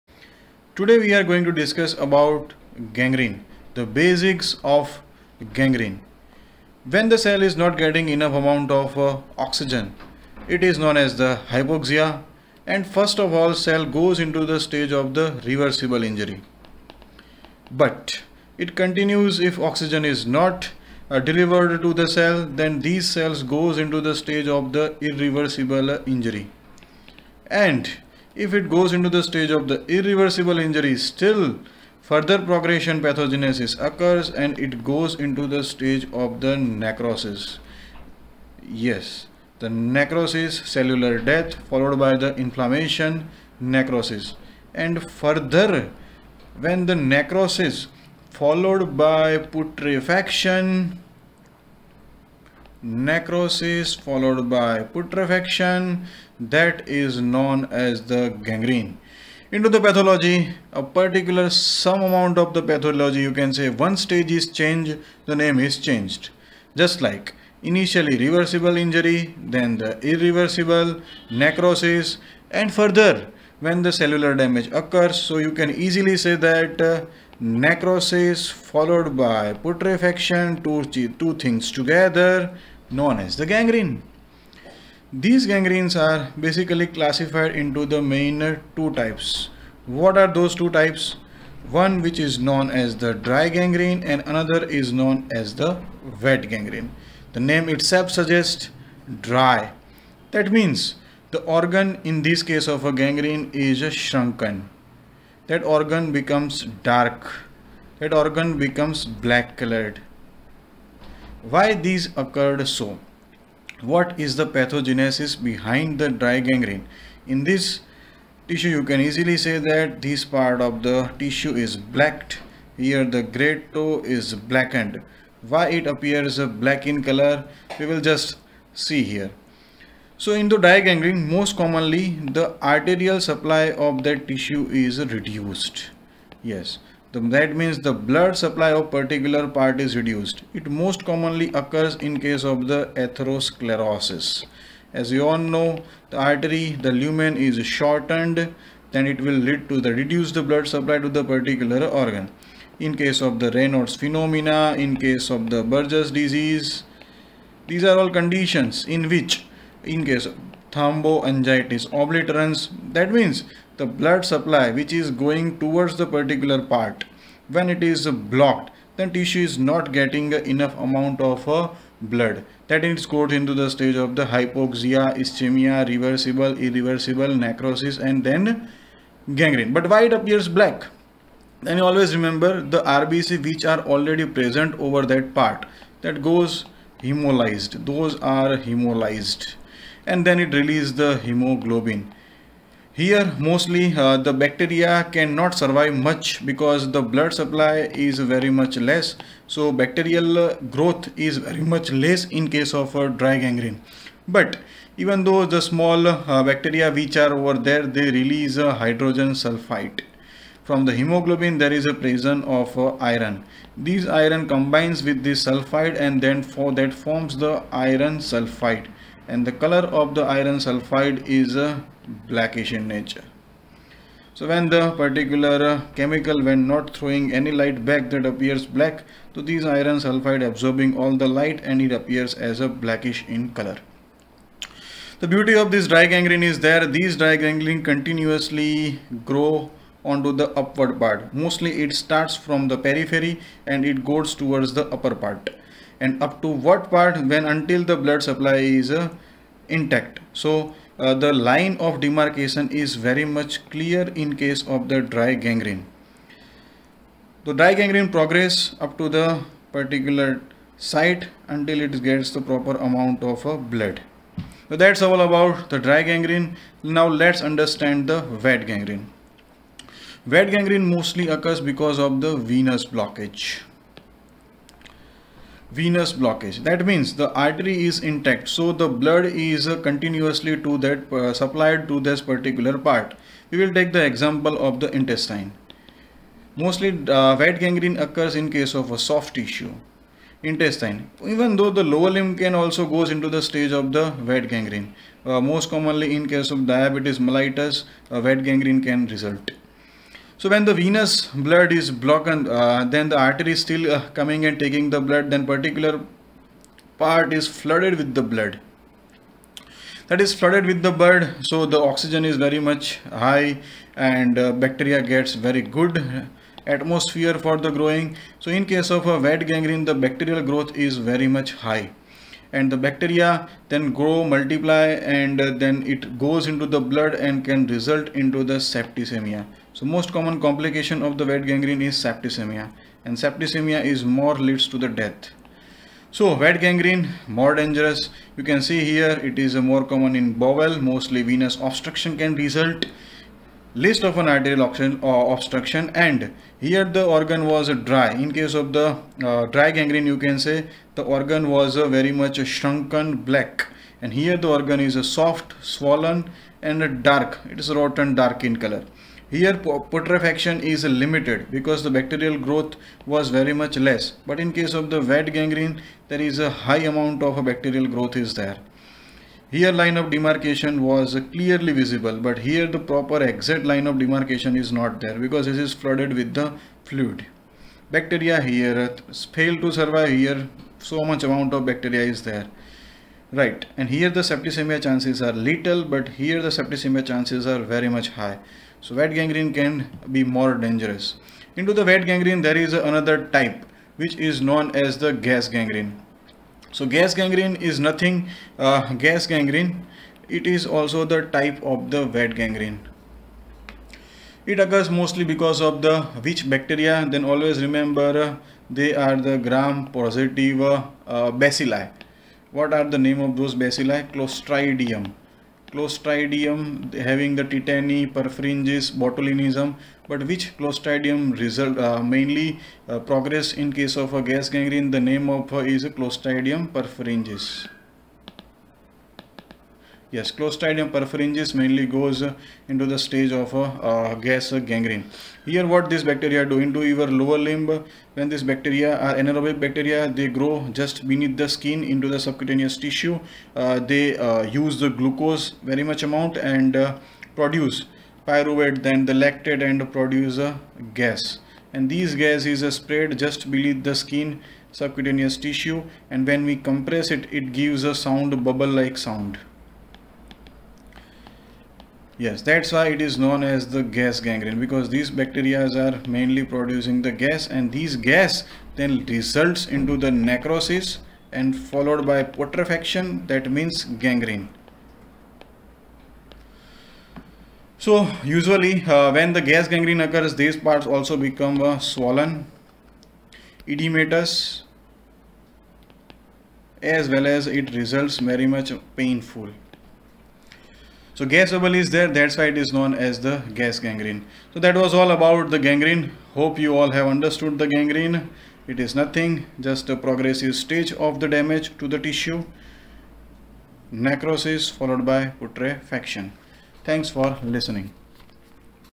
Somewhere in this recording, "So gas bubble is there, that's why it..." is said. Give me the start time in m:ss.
8:11.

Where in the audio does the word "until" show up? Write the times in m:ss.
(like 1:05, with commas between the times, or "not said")
4:07, 4:21.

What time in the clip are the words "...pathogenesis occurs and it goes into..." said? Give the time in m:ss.
0:33.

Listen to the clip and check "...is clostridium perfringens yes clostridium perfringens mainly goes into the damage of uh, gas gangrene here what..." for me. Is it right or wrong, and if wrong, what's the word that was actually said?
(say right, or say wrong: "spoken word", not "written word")
wrong: "stage", not "damage".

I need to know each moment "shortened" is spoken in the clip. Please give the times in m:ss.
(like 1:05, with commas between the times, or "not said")
2:27.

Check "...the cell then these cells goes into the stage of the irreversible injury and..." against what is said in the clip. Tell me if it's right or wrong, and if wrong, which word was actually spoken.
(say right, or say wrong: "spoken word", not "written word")
right.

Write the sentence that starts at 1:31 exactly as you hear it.
One which is known as the dry gangrene and another is known as the wet gangrene.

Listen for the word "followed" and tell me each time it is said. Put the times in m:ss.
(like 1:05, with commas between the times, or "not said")
0:41, 0:48, 0:53, 1:18, 7:51, 8:24.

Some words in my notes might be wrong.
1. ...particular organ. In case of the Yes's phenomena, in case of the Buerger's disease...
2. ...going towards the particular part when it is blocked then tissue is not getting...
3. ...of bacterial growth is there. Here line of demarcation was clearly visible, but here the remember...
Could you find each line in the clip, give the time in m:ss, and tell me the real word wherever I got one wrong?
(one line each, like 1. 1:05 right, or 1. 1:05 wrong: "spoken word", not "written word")
1. 2:31 wrong: "Raynaud", not "Yes"
2. 2:45 right
3. 6:07 wrong: "proper", not "remember".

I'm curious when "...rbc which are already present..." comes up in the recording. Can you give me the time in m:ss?
3:02.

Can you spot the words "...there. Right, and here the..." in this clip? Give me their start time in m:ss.
6:22.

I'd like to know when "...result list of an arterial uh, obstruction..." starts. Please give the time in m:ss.
5:42.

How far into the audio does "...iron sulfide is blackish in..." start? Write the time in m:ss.
3:40.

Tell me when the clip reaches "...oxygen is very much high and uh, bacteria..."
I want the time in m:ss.
5:11.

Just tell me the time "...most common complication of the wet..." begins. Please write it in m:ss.
5:29.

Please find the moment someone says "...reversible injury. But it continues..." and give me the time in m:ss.
0:15.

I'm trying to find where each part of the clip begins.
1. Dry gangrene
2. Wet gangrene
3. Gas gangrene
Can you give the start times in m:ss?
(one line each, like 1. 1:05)
1. 1:30
2. 4:30
3. 6:40.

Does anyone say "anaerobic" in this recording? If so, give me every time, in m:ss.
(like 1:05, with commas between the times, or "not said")
7:19.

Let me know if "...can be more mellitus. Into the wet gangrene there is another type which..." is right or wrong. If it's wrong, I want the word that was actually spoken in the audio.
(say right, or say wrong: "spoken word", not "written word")
wrong: "dangerous", not "mellitus".